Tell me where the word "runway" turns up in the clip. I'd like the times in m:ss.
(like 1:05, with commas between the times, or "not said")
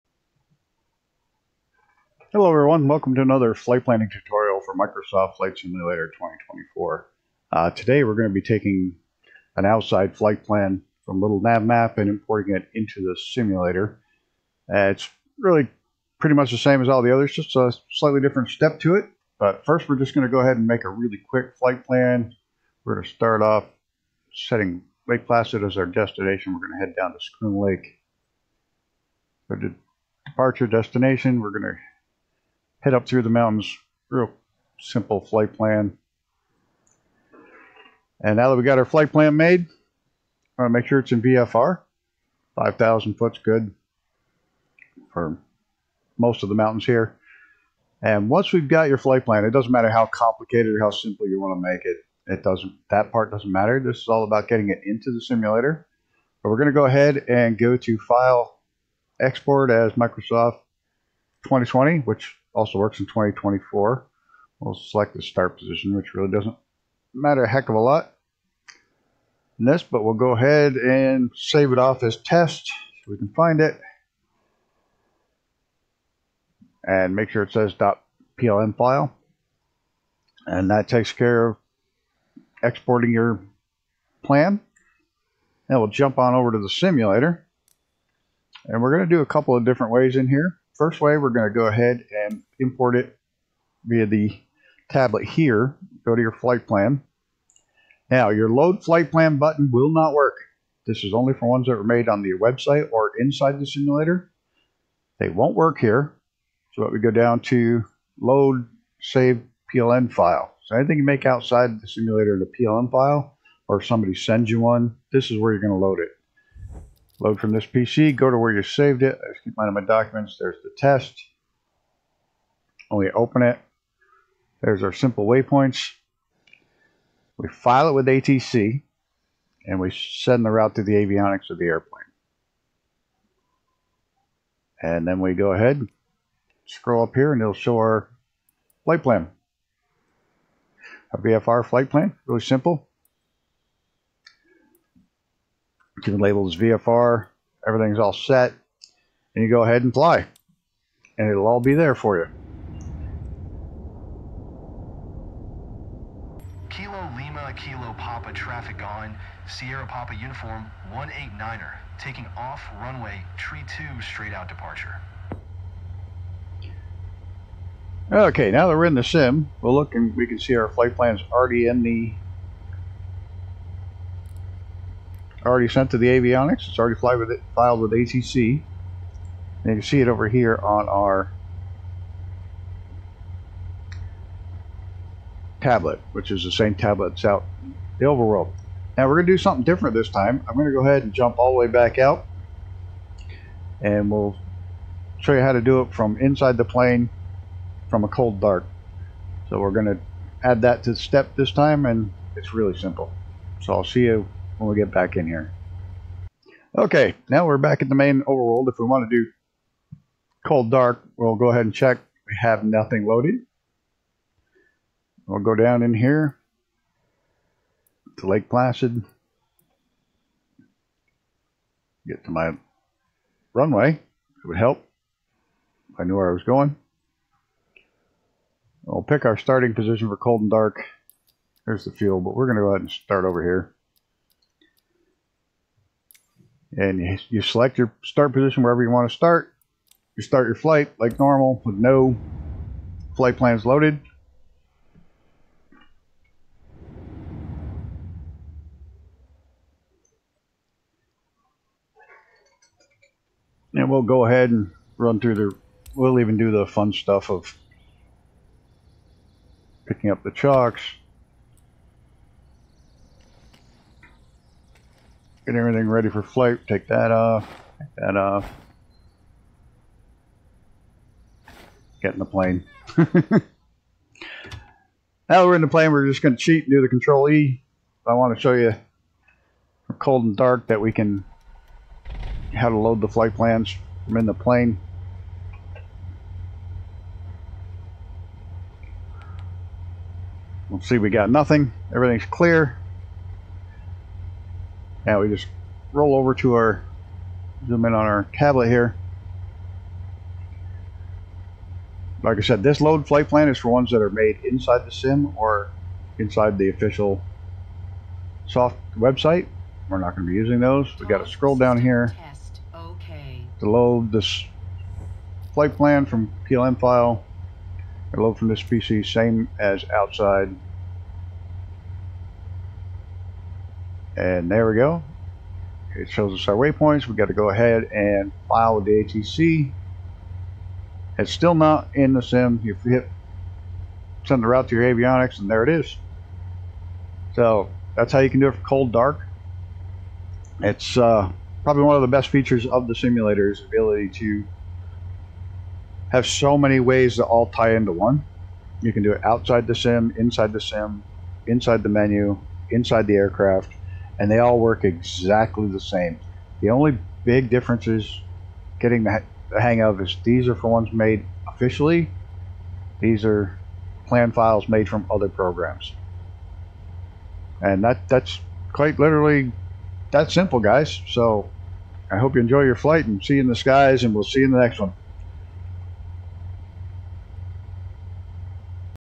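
2:42, 3:43.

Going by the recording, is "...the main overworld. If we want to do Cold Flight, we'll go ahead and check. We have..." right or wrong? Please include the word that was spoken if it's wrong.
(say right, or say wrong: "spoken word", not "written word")
wrong: "Dark", not "Flight".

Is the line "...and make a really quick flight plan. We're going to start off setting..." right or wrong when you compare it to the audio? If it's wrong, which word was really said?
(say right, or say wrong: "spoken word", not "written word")
right.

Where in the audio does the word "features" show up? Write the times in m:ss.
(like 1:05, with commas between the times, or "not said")
5:42.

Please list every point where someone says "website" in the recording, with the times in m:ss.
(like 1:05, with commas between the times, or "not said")
1:42, 5:08.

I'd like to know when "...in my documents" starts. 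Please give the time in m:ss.
1:59.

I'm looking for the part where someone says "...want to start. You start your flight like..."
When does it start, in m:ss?
3:58.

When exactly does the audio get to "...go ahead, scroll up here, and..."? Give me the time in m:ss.
2:15.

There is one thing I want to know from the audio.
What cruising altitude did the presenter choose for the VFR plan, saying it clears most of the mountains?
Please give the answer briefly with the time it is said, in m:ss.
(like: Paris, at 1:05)
5,000 feet, at 0:42.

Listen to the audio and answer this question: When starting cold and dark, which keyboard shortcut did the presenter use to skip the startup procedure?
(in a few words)
Control E.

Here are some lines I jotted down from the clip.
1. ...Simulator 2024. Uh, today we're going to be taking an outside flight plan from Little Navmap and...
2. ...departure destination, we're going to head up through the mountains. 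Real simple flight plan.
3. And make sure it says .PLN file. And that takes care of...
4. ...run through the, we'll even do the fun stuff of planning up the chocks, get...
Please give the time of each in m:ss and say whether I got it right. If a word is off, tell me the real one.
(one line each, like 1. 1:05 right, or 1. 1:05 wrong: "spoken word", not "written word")
1. 0:05 right
2. 0:30 right
3. 1:16 right
4. 4:14 wrong: "picking", not "planning".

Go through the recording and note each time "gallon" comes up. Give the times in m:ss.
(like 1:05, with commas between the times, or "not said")
not said.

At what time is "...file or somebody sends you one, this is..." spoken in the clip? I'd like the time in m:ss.
1:52.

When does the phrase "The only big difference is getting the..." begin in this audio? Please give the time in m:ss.
5:56.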